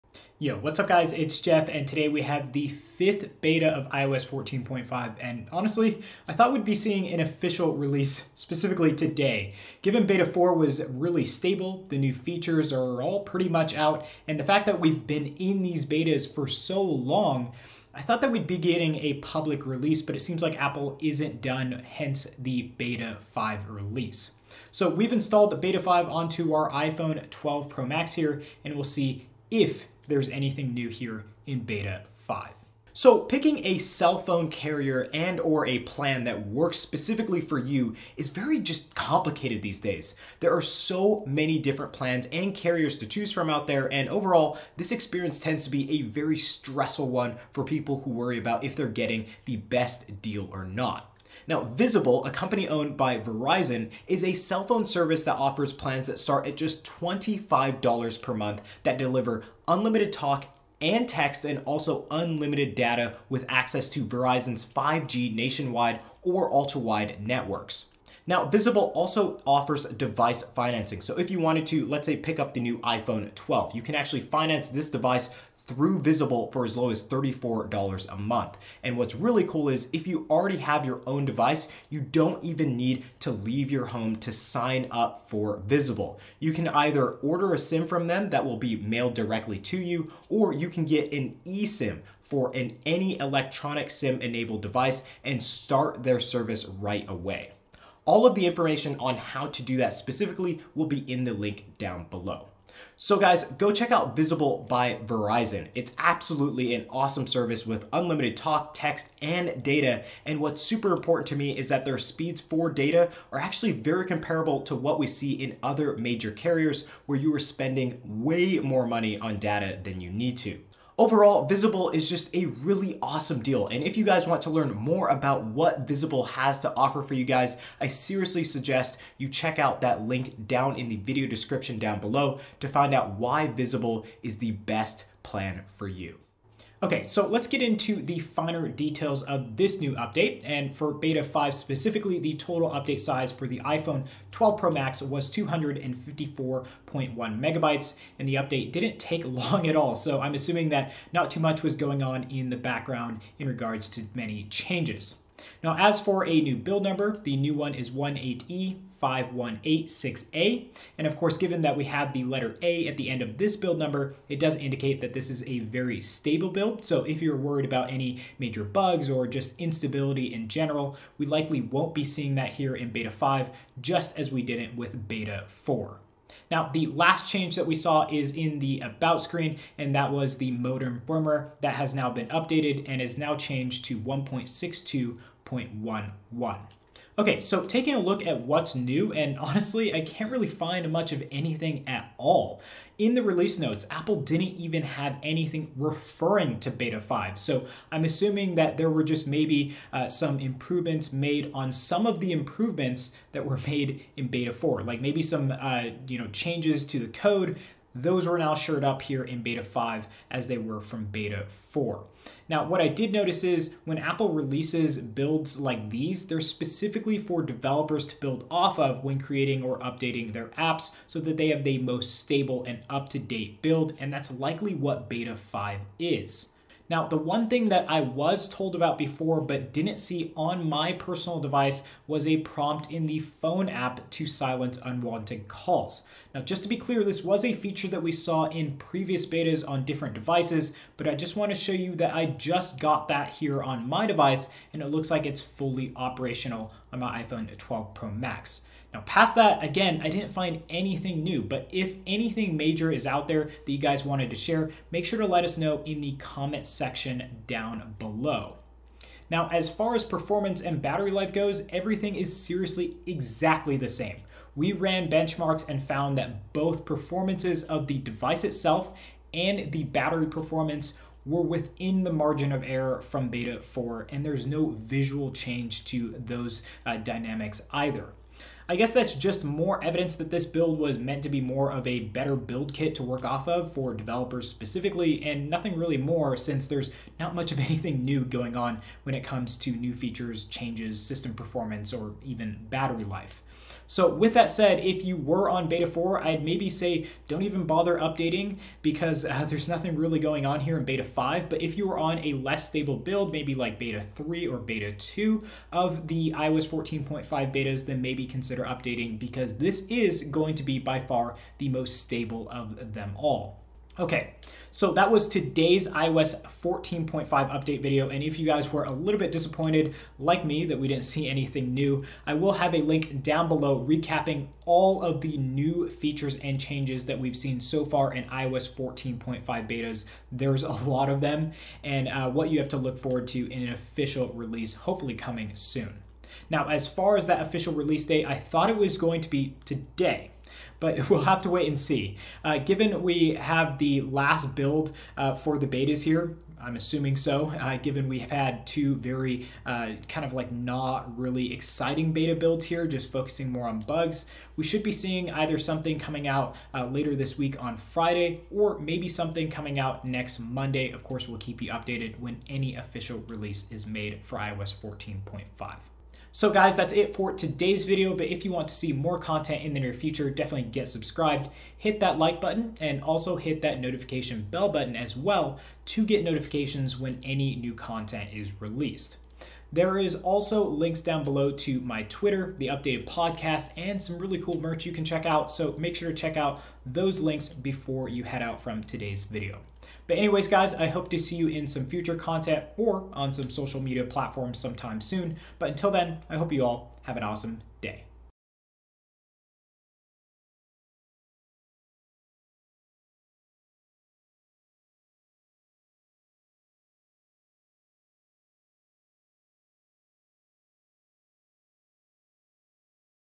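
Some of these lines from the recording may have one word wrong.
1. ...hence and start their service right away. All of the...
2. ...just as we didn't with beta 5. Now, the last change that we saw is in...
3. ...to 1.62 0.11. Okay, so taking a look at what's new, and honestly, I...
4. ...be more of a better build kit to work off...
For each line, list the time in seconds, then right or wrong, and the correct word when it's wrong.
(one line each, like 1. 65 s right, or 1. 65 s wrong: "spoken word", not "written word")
1. 94 s wrong: "device", not "hence"
2. 173 s wrong: "4", not "5"
3. 183 s right
4. 281 s right.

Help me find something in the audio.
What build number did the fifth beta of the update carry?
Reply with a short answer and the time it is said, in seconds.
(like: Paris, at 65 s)
18E5186A, at 157 s.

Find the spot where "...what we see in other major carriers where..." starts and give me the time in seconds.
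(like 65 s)
114 s.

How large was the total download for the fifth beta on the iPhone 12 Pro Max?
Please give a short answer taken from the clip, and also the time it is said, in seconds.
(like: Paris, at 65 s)
254.1 megabytes, at 145 s.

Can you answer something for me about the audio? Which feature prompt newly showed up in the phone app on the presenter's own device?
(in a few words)
silence unwanted calls.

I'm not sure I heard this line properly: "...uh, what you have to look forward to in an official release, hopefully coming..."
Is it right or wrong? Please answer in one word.
right.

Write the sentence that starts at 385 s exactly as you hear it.
So make sure to check out those links before you head out from today's video.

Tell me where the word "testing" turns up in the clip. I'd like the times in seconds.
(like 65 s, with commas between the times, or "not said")
not said.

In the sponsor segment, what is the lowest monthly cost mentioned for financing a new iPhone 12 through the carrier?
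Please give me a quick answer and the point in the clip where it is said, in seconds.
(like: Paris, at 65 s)
$34, at 77 s.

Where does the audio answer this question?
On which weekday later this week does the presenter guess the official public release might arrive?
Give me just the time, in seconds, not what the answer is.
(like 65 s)
357 s.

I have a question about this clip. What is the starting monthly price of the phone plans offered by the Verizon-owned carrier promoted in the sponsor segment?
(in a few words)
$25.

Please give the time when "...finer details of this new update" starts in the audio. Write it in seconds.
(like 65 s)
138 s.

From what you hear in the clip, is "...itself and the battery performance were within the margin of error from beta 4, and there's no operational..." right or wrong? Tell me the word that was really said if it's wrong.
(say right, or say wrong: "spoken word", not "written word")
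wrong: "visual", not "operational".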